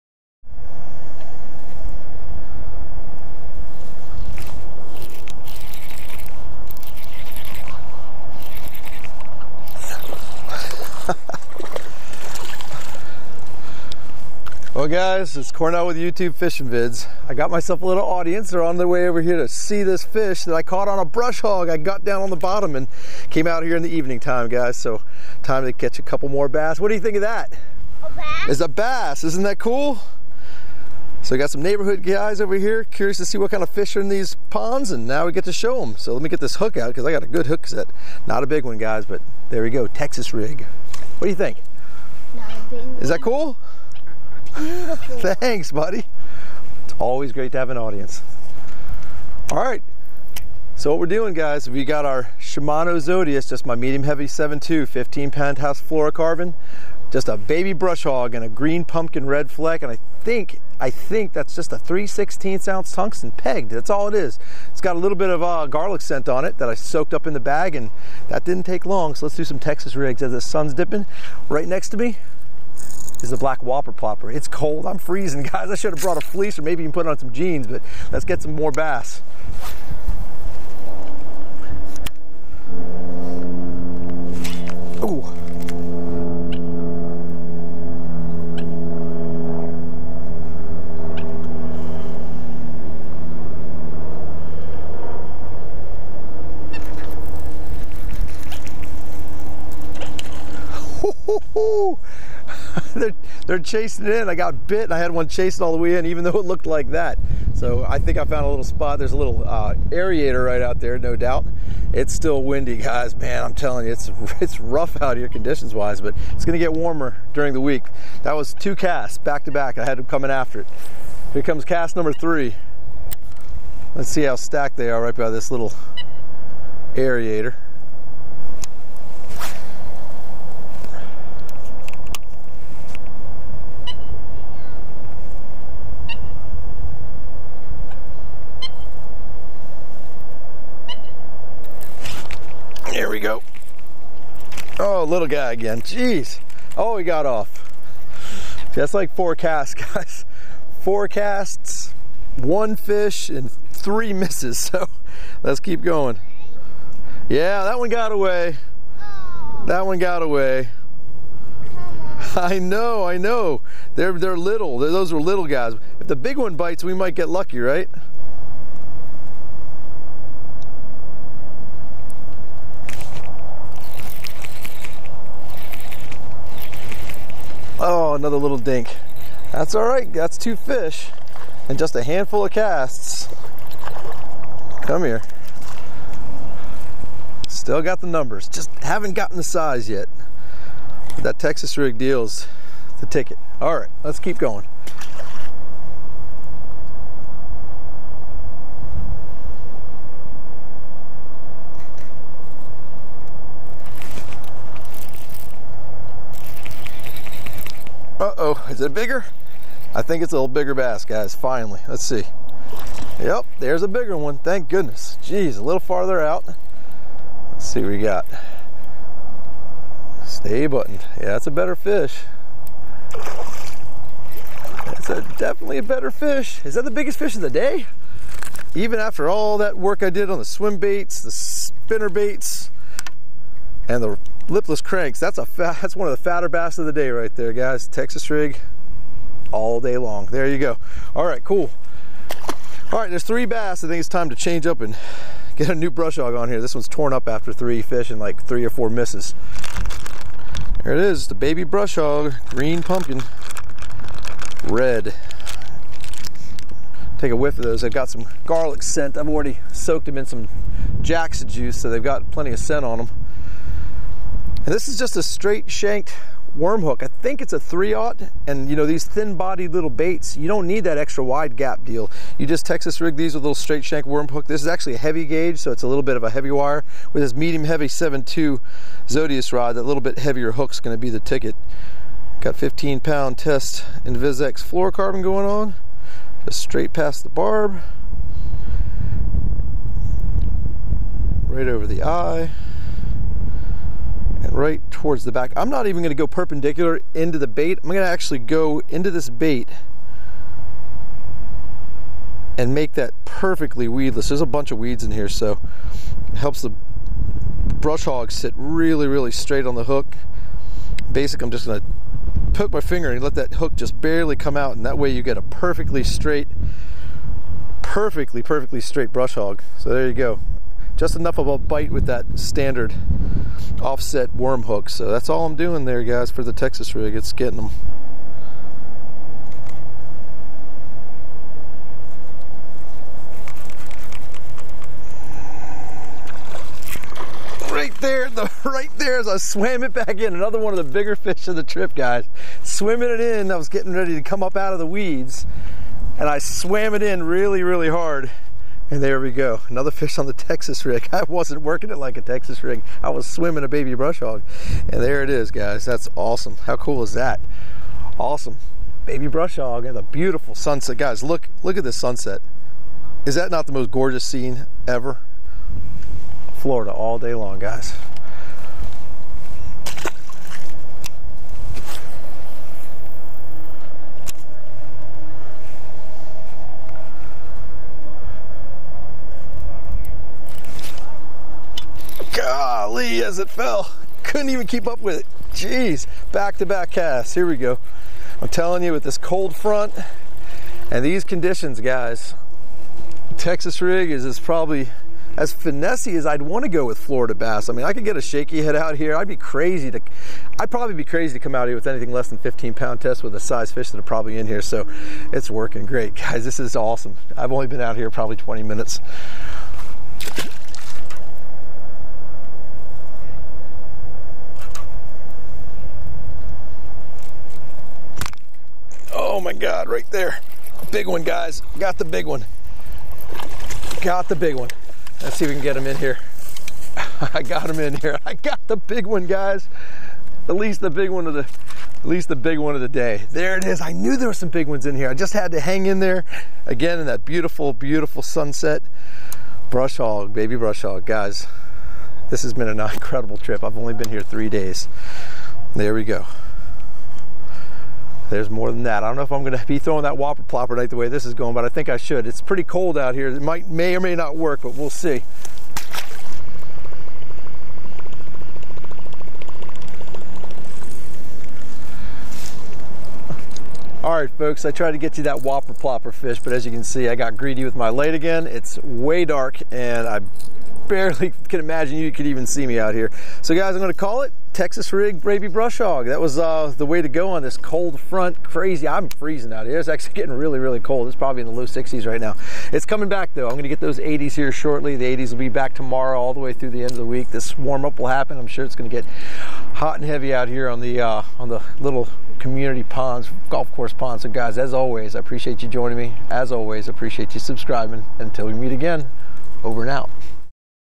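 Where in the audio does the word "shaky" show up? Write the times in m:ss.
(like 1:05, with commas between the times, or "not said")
6:38.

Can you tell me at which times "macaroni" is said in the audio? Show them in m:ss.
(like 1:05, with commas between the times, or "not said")
not said.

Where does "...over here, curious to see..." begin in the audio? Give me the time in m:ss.
0:32.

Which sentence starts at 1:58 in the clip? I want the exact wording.
That was two casts back to back.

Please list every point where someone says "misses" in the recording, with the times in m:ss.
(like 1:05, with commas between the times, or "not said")
2:34, 4:08.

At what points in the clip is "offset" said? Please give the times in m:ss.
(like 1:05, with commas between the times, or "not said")
5:23.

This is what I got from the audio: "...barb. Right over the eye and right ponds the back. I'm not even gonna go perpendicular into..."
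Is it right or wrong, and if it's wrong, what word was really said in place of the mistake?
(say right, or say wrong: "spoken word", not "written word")
wrong: "towards", not "ponds".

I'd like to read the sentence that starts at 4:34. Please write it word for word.
This is actually a heavy gauge, so it's a little bit of a heavy wire.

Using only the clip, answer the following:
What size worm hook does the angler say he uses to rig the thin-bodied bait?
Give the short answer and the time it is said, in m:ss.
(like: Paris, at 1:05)
3-aught, at 4:27.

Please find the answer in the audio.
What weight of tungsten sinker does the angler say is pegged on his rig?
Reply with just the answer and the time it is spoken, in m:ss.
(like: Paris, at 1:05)
3/16 ounce, at 1:01.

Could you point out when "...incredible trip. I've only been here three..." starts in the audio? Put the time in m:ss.
7:22.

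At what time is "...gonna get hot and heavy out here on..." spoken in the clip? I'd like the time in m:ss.
8:08.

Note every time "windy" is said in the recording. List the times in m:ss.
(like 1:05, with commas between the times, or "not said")
1:52.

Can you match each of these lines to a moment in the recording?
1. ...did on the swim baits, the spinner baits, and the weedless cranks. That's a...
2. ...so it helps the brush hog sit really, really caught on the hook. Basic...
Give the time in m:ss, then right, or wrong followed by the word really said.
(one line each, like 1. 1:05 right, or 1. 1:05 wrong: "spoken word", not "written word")
1. 3:50 wrong: "lipless", not "weedless"
2. 5:05 wrong: "straight", not "caught".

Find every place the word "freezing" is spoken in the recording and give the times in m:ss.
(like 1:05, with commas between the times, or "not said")
1:14, 7:59.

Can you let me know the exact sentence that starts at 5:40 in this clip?
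Another one of the bigger fish of the trip, guys.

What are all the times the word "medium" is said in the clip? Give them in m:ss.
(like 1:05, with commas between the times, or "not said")
0:53, 4:37.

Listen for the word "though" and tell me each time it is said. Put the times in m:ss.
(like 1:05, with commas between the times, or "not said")
1:46, 8:03.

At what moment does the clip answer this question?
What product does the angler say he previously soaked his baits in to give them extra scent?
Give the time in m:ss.
4:21.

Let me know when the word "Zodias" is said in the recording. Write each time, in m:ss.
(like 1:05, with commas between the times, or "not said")
0:52, 4:39.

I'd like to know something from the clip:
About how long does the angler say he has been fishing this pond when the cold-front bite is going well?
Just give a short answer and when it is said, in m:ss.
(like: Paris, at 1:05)
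20 minutes, at 6:48.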